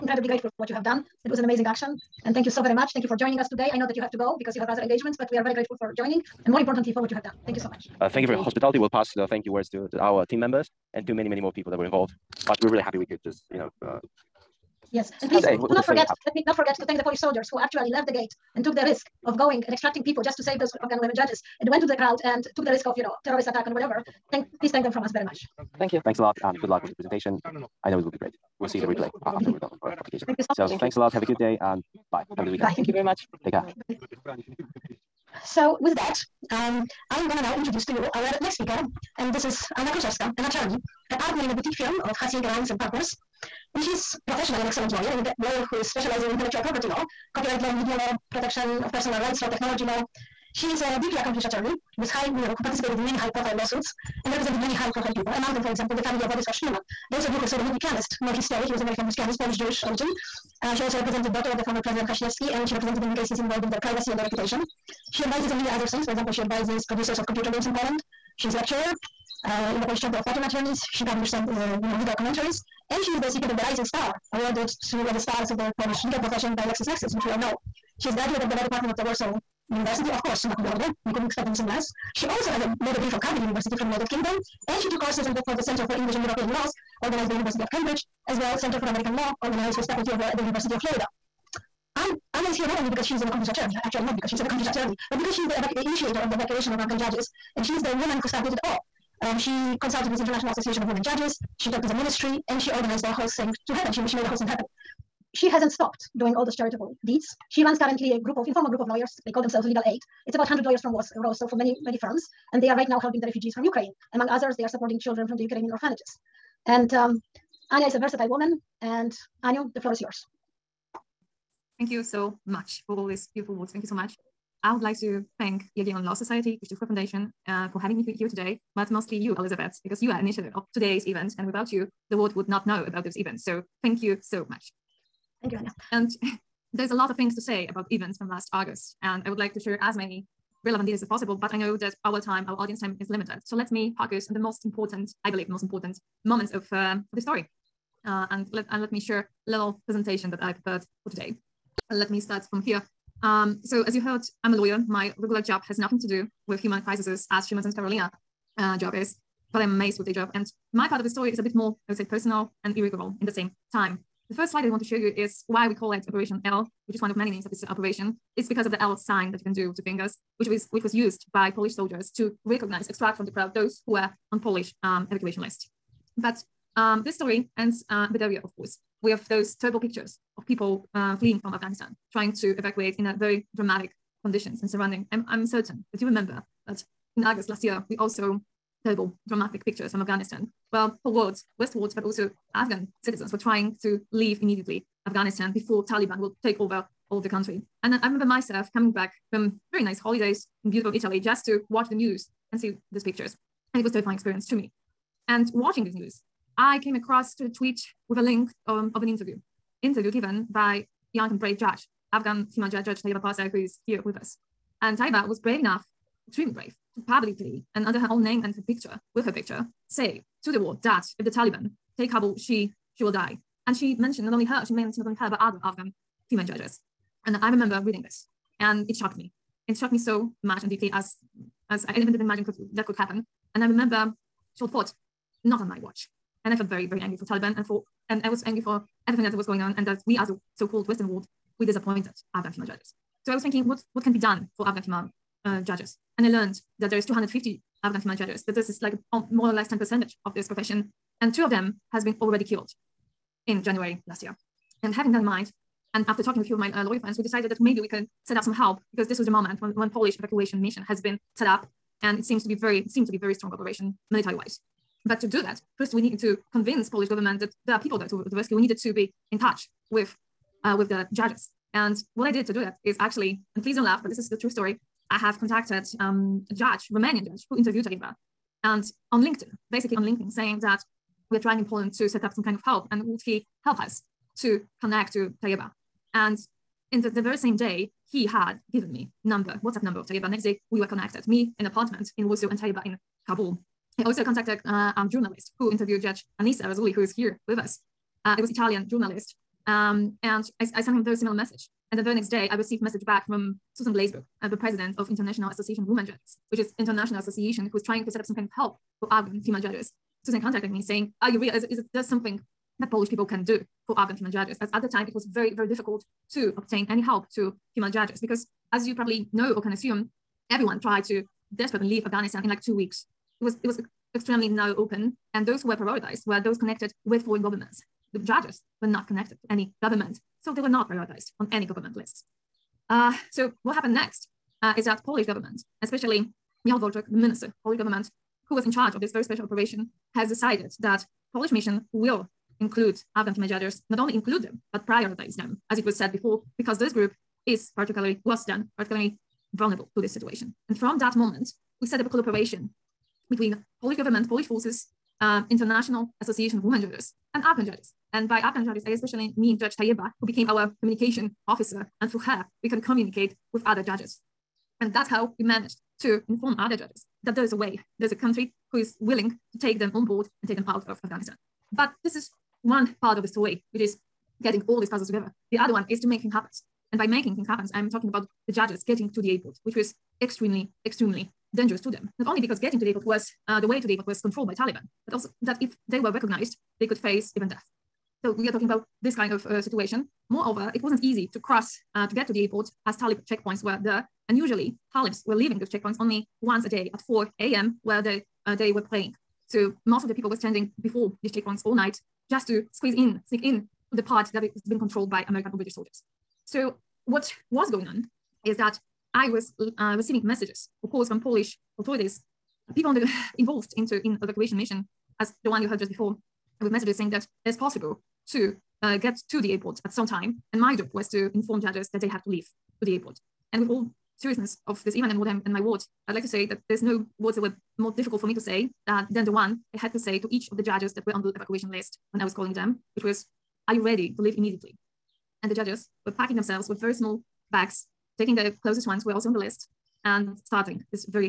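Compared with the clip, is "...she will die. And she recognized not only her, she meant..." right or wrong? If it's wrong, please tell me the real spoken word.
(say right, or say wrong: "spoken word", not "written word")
wrong: "mentioned", not "recognized".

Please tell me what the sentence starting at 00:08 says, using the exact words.
We'll pass the thank you words to, to our team members and to many, many more people that were involved.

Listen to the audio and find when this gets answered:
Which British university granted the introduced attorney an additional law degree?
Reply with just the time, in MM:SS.
01:23.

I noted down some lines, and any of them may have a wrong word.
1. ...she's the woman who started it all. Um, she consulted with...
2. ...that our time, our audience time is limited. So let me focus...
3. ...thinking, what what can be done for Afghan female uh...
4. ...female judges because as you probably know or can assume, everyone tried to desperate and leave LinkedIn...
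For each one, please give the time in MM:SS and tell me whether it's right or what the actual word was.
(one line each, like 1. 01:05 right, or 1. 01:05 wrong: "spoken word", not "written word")
1. 01:37 right
2. 02:21 right
3. 04:03 right
4. 05:17 wrong: "Afghanistan", not "LinkedIn".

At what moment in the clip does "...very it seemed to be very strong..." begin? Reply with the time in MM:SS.
04:22.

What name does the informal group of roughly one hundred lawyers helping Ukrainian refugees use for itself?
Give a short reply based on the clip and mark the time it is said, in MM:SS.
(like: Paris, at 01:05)
Legal Aid, at 01:49.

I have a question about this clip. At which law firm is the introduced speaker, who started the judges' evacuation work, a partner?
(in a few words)
Hasik Rheims and Partners.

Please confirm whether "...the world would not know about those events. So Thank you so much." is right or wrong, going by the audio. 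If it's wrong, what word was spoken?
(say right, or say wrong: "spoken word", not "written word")
right.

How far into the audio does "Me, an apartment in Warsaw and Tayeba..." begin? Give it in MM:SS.
04:51.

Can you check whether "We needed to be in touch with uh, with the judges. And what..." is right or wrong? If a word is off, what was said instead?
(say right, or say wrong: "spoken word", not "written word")
right.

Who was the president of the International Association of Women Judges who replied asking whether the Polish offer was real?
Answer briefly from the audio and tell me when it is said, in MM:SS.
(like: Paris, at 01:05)
Susan Glazebrook, at 05:03.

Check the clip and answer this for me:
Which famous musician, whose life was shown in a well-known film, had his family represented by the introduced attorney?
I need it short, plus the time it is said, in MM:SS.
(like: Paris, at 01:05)
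Władysław Szpilman, at 00:56.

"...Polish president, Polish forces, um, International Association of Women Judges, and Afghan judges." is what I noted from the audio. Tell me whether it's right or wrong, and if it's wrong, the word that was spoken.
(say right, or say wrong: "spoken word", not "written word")
wrong: "government", not "president".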